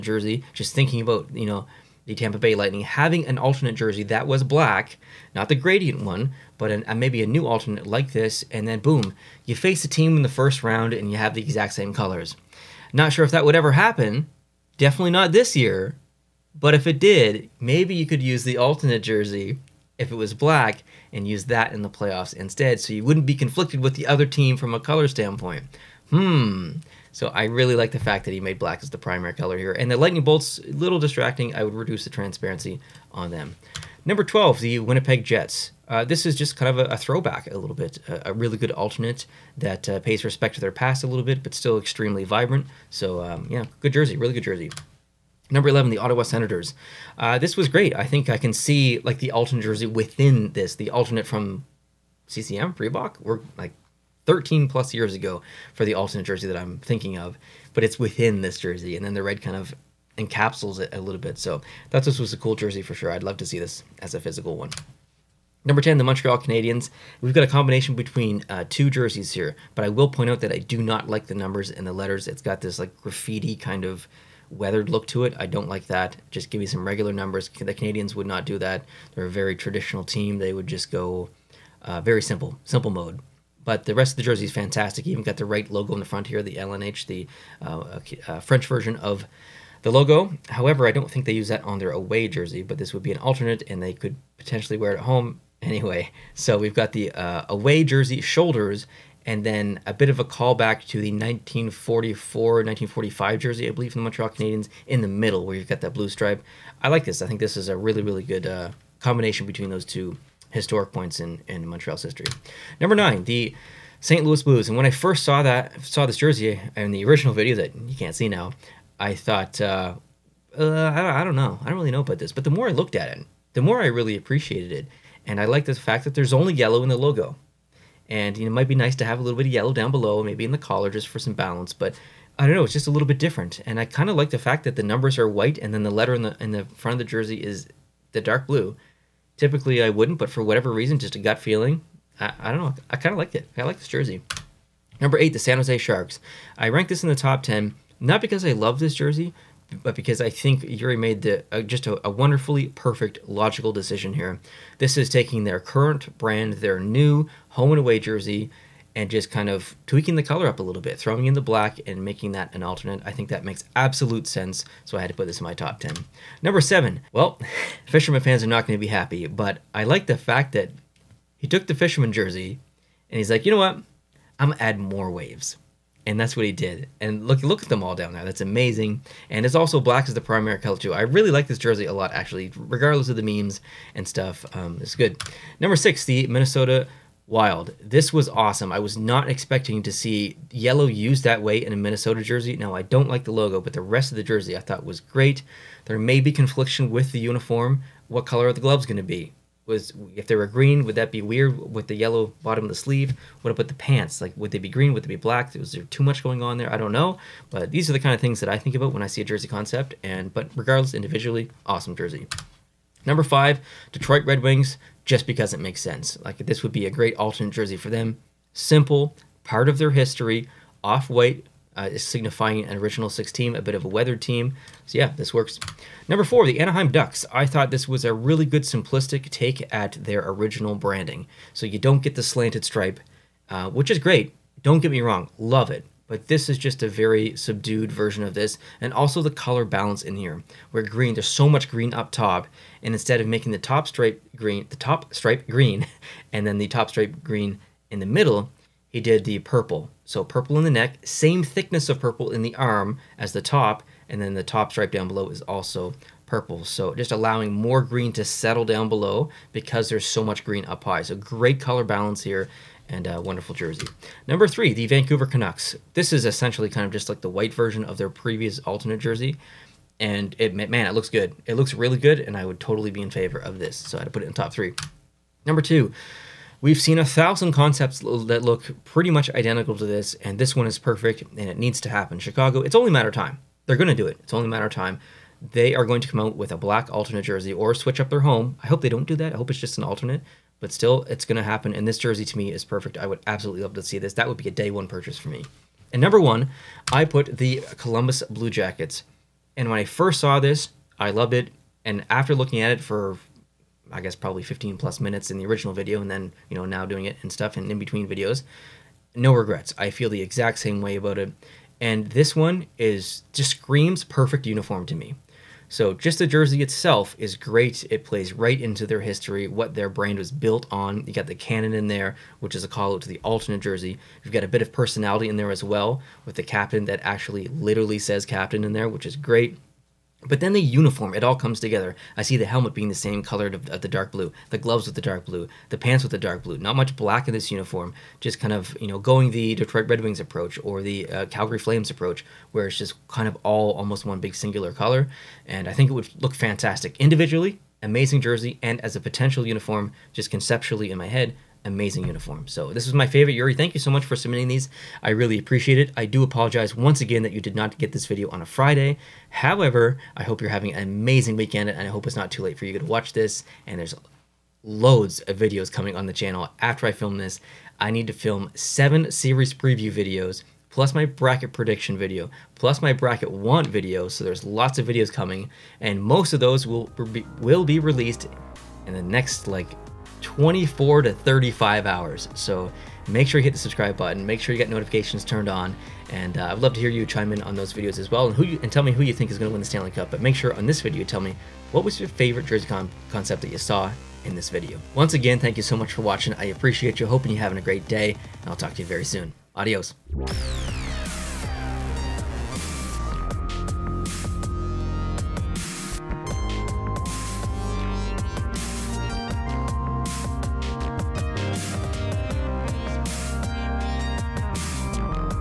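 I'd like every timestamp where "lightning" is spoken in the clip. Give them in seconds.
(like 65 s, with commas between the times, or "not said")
2 s, 29 s.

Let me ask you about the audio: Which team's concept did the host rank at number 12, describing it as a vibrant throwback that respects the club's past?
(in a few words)
Winnipeg Jets.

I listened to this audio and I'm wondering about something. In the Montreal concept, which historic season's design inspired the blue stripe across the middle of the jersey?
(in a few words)
1944-1945.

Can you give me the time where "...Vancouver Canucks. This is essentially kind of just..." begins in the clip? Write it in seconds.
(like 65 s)
264 s.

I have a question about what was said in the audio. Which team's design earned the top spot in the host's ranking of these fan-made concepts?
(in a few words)
Columbus Blue Jackets.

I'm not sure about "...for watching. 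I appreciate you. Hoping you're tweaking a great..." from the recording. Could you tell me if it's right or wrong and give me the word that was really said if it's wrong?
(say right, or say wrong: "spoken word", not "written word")
wrong: "having", not "tweaking".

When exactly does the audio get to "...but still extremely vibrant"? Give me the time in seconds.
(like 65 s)
41 s.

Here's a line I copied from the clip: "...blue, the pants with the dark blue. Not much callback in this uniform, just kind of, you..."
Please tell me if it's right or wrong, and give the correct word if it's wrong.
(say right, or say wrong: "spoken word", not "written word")
wrong: "black", not "callback".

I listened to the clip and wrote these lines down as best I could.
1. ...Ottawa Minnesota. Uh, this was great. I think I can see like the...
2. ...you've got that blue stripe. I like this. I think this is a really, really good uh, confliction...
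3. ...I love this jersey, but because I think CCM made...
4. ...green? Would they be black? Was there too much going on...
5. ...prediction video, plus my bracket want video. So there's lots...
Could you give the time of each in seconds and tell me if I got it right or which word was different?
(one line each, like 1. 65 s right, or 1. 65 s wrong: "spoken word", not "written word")
1. 45 s wrong: "Senators", not "Minnesota"
2. 105 s wrong: "combination", not "confliction"
3. 148 s wrong: "Yuri", not "CCM"
4. 204 s right
5. 371 s right.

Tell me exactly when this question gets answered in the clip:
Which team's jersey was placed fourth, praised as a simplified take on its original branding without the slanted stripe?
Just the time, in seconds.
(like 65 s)
226 s.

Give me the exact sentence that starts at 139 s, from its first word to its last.
Typically, I wouldn't, but for whatever reason, just a gut feeling, I, I don't know.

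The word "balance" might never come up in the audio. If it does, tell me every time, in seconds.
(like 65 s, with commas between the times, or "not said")
131 s, 239 s, 261 s.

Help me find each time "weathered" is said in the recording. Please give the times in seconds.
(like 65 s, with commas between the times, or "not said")
74 s, 223 s.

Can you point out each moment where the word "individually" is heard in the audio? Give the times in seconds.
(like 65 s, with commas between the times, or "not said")
210 s, 346 s.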